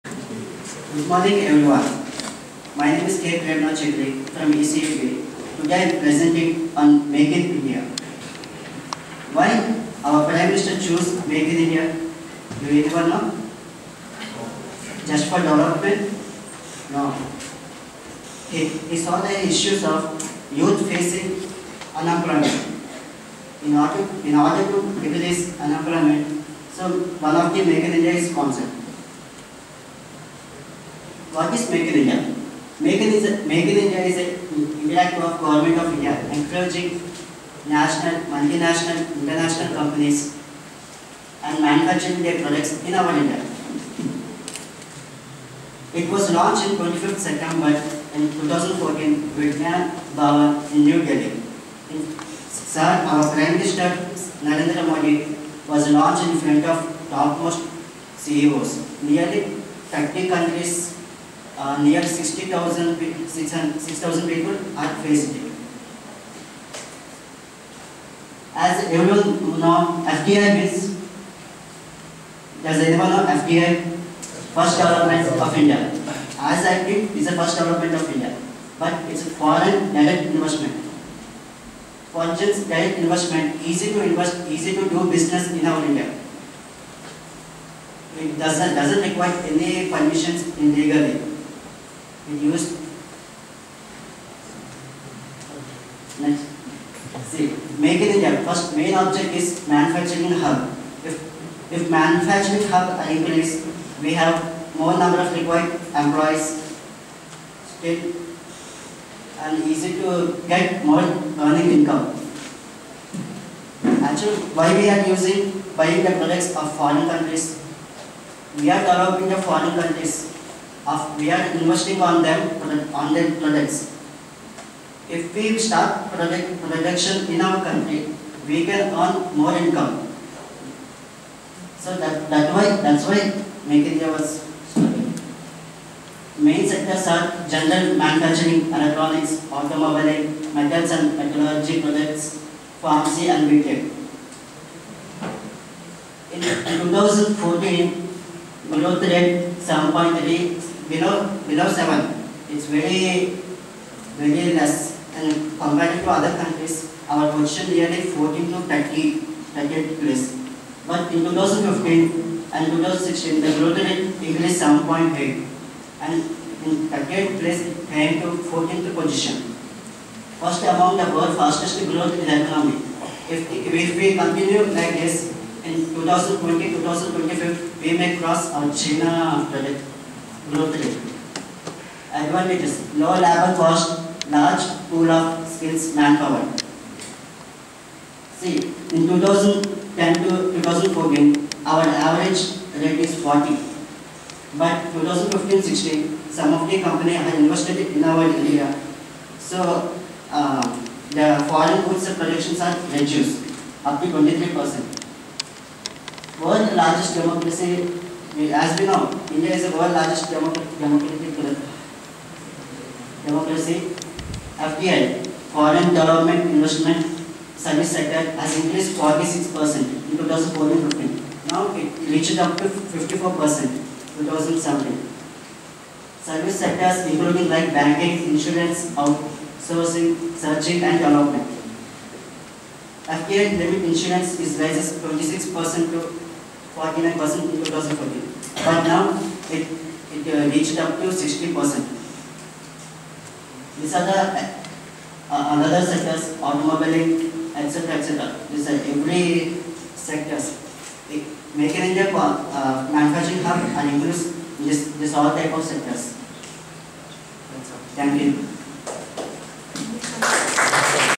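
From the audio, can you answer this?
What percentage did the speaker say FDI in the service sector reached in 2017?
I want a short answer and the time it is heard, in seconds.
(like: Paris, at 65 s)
54%, at 222 s.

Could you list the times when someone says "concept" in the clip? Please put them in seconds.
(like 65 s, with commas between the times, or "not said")
28 s.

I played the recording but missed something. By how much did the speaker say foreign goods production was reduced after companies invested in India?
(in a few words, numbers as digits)
23%.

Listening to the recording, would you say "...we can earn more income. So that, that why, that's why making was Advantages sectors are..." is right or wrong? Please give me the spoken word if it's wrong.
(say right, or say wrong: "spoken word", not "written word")
wrong: "Main", not "Advantages".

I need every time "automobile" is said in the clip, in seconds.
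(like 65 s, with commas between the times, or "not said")
139 s, 246 s.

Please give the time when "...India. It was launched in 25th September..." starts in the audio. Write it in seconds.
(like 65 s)
43 s.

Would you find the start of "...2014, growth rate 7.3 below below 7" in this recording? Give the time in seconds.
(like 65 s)
146 s.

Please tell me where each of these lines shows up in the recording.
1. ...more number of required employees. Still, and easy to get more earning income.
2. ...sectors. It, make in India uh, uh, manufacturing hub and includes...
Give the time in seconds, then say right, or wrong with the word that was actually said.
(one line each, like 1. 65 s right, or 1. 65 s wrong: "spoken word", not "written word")
1. 104 s right
2. 249 s right.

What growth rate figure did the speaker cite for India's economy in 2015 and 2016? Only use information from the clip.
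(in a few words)
7.8.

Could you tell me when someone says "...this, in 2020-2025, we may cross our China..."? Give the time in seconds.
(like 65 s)
174 s.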